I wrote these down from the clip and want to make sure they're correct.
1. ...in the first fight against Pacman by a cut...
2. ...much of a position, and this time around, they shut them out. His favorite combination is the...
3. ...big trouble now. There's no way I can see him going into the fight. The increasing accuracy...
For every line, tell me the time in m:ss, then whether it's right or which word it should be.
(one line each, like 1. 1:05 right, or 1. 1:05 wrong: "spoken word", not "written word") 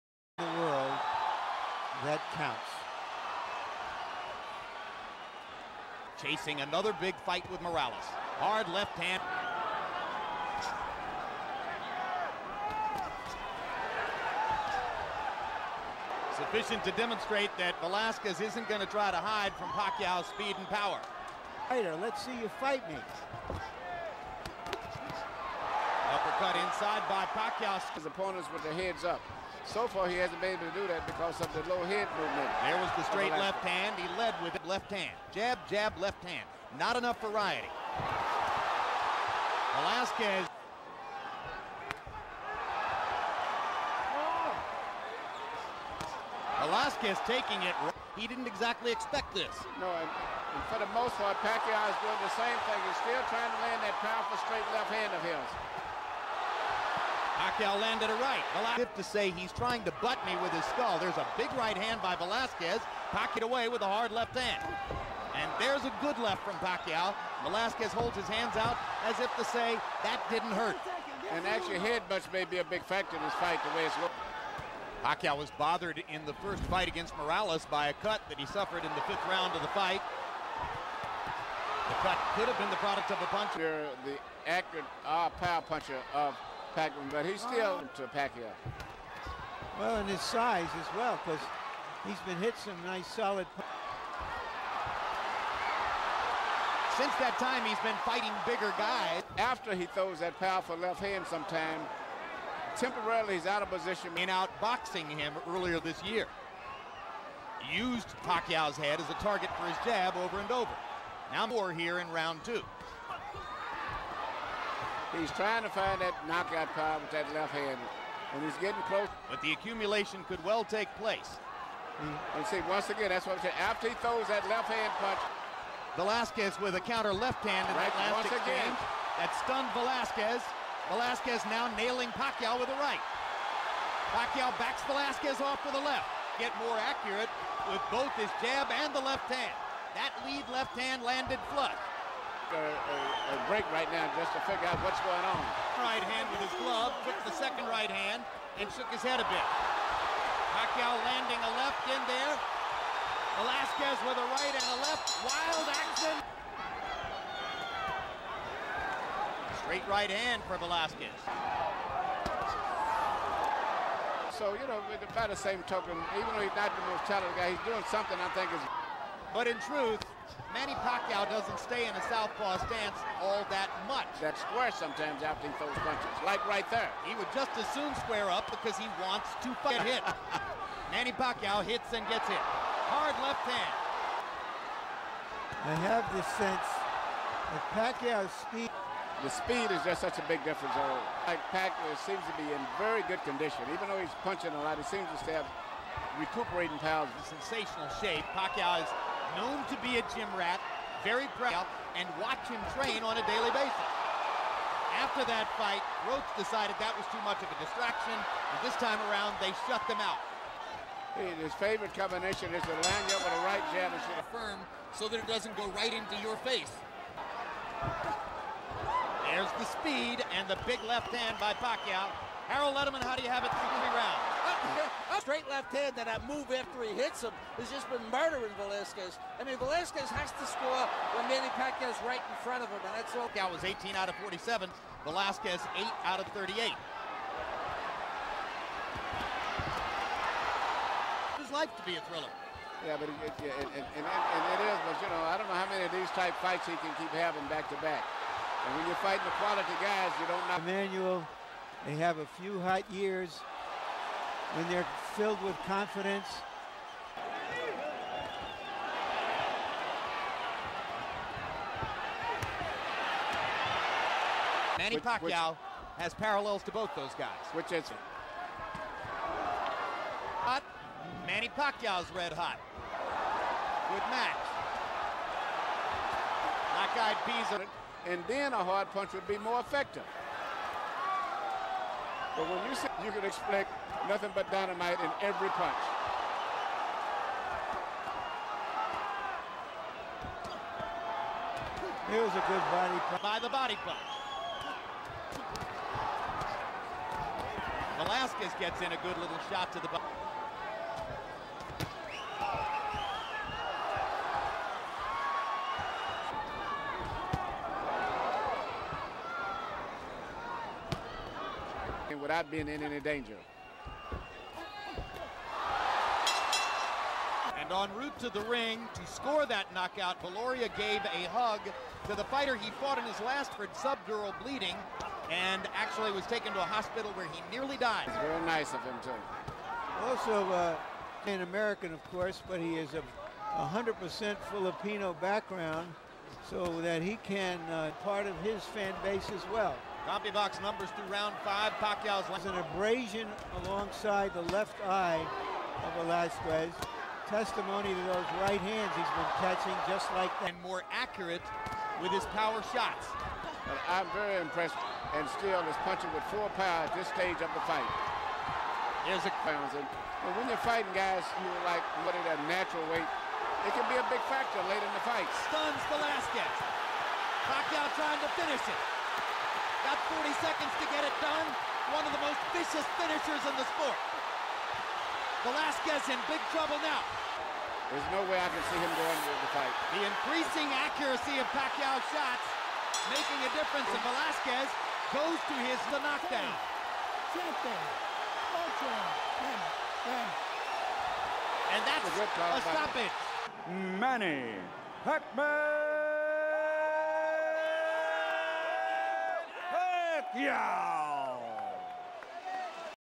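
1. 1:16 wrong: "Morales", not "Pacman"
2. 3:27 wrong: "distraction", not "position"
3. 6:16 right.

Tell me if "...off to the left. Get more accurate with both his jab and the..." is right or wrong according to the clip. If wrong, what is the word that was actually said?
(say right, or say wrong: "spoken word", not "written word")
right.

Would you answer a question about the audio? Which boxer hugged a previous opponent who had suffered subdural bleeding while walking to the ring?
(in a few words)
Viloria.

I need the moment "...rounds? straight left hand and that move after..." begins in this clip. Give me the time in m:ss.
3:43.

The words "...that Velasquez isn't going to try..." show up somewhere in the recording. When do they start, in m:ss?
0:17.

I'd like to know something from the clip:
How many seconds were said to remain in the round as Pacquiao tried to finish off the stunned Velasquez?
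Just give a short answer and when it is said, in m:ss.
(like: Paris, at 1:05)
40, at 6:10.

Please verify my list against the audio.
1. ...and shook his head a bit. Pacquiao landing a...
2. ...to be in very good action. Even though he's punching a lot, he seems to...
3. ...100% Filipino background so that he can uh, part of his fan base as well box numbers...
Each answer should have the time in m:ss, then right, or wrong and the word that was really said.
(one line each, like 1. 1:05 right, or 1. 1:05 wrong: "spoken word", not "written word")
1. 2:28 right
2. 3:12 wrong: "condition", not "action"
3. 5:33 right.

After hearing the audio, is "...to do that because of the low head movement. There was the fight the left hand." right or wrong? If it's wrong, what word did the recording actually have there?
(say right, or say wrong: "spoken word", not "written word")
wrong: "straight", not "fight".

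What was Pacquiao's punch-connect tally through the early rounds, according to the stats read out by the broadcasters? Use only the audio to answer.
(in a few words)
18 out of 47.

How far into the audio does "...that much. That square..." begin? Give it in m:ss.
2:53.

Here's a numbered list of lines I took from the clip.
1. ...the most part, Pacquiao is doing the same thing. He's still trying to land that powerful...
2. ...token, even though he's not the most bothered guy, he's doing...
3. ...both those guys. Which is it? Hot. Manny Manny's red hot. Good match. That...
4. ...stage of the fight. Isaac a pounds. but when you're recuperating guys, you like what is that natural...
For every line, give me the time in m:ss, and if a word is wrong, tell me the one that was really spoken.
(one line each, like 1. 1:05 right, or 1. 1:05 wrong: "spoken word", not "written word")
1. 0:50 right
2. 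2:45 wrong: "talented", not "bothered"
3. 4:26 wrong: "Pacquiao", not "Manny"
4. 5:57 wrong: "fighting", not "recuperating".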